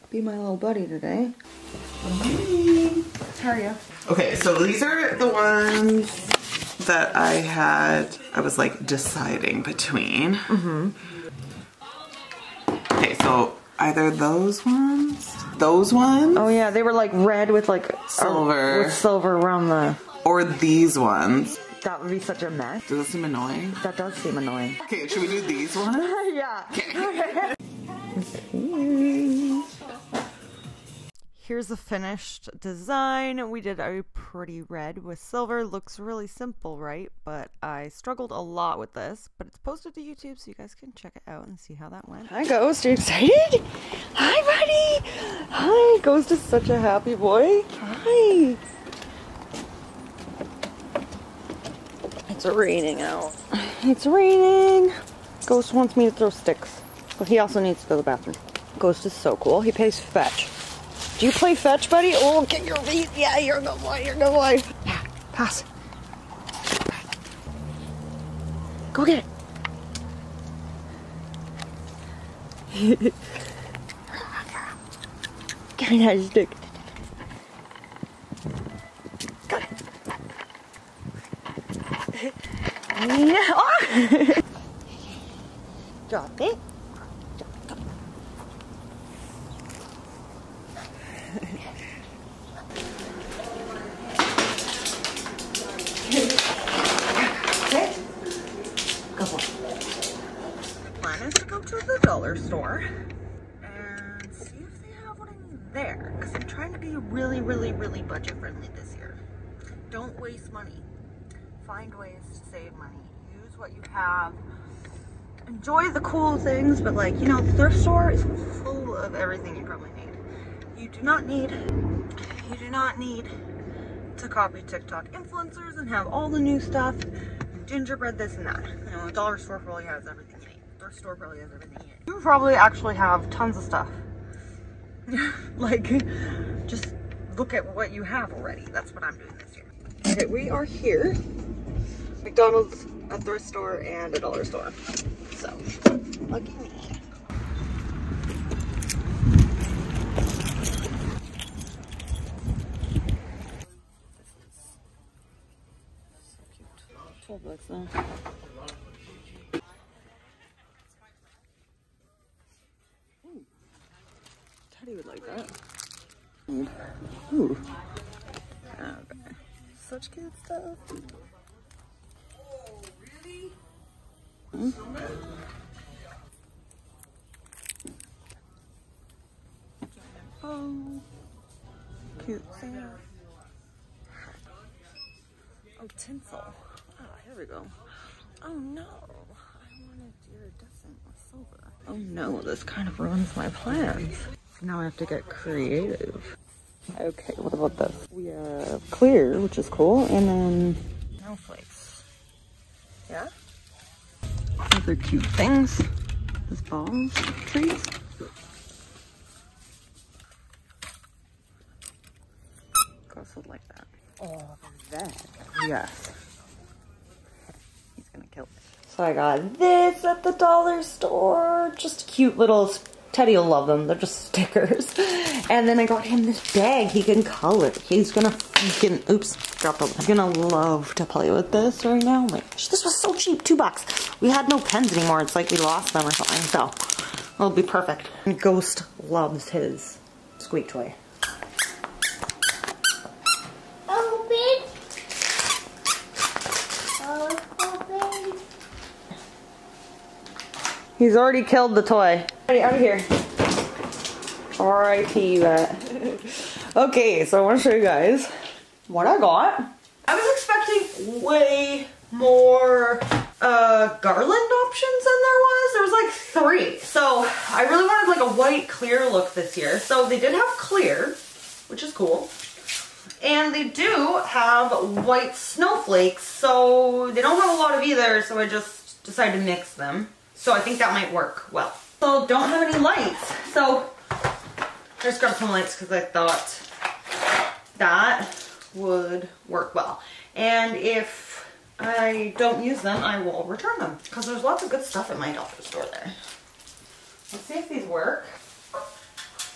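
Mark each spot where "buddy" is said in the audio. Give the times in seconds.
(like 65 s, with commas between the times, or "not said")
0 s, 45 s, 61 s.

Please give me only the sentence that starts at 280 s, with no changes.
So I think that might work well.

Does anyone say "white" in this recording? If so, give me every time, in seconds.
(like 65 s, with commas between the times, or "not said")
268 s, 275 s.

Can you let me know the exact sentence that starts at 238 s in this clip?
And Ghost loves his squeak toy.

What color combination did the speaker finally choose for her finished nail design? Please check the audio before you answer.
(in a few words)
red with silver.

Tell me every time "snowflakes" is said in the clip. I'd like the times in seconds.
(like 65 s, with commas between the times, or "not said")
201 s, 275 s.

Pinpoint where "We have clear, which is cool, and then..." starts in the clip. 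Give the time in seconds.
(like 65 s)
198 s.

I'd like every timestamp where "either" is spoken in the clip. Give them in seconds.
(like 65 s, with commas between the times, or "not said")
13 s, 277 s.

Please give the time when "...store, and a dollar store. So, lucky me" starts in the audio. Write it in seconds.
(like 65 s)
143 s.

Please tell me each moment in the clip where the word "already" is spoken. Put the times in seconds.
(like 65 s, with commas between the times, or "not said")
138 s, 251 s.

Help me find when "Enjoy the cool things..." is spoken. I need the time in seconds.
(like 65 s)
115 s.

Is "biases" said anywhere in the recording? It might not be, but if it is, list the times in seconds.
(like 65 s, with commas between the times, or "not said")
not said.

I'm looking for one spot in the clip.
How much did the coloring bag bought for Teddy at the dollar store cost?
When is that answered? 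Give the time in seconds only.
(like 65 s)
233 s.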